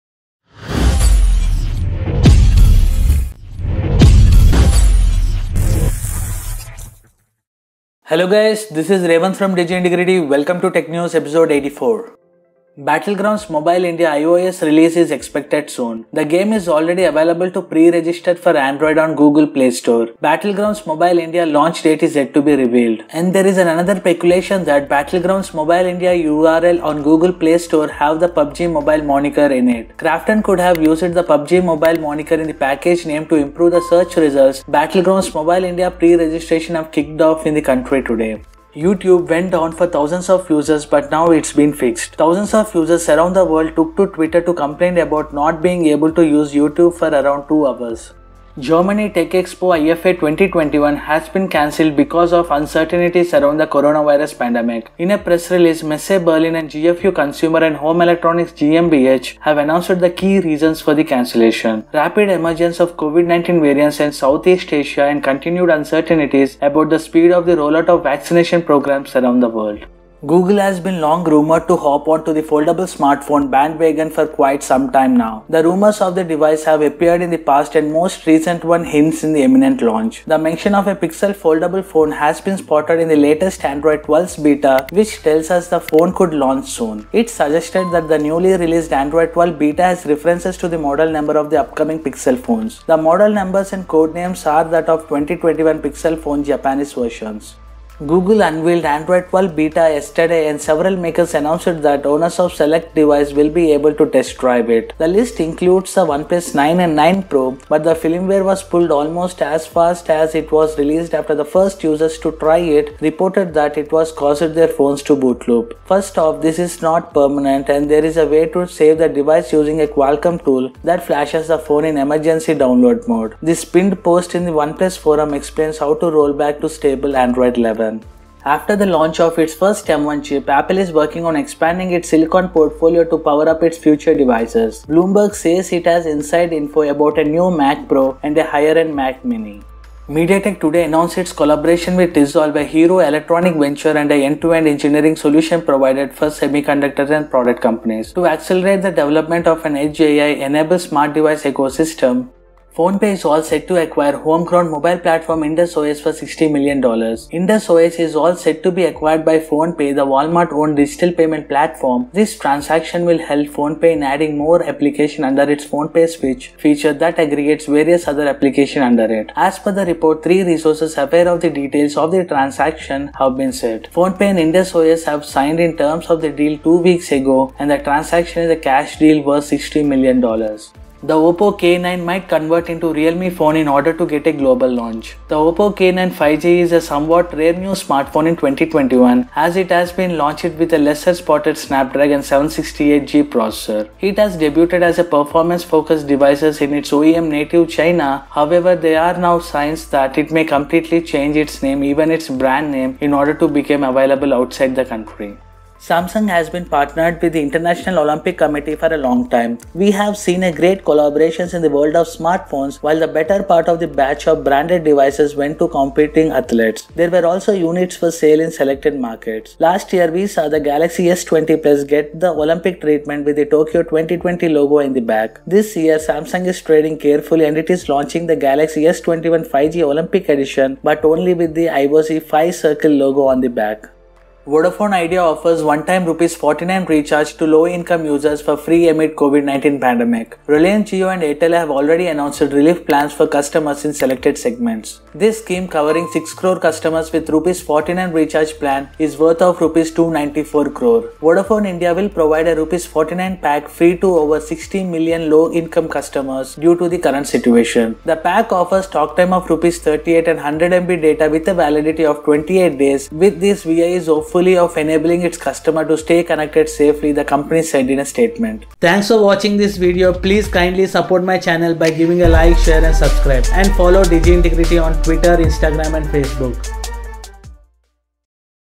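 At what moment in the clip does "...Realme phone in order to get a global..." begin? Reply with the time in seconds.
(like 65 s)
182 s.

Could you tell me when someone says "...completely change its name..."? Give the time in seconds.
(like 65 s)
200 s.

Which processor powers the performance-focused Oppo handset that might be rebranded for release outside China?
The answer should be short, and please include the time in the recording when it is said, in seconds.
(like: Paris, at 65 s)
Snapdragon 768G, at 191 s.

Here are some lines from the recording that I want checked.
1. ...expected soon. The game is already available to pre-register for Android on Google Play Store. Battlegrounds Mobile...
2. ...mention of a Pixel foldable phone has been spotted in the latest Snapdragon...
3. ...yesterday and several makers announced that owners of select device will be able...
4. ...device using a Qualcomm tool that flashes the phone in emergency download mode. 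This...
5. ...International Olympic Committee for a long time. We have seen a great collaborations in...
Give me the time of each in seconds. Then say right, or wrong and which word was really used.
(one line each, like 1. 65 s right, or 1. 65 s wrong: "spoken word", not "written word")
1. 15 s right
2. 80 s wrong: "Android", not "Snapdragon"
3. 99 s right
4. 119 s right
5. 207 s right.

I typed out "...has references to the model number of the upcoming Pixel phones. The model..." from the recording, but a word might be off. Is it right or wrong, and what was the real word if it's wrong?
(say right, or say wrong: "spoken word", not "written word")
right.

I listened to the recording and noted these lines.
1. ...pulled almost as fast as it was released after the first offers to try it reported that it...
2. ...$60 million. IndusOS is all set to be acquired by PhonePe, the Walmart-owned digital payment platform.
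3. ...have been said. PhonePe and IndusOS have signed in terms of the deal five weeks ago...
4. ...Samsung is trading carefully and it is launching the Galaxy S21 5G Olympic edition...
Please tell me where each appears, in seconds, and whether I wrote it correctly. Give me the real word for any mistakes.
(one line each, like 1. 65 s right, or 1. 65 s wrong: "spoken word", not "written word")
1. 108 s wrong: "users", not "offers"
2. 156 s right
3. 173 s wrong: "two", not "five"
4. 225 s right.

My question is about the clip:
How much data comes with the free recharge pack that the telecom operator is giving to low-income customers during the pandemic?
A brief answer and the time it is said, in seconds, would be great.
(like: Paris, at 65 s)
100 MB, at 260 s.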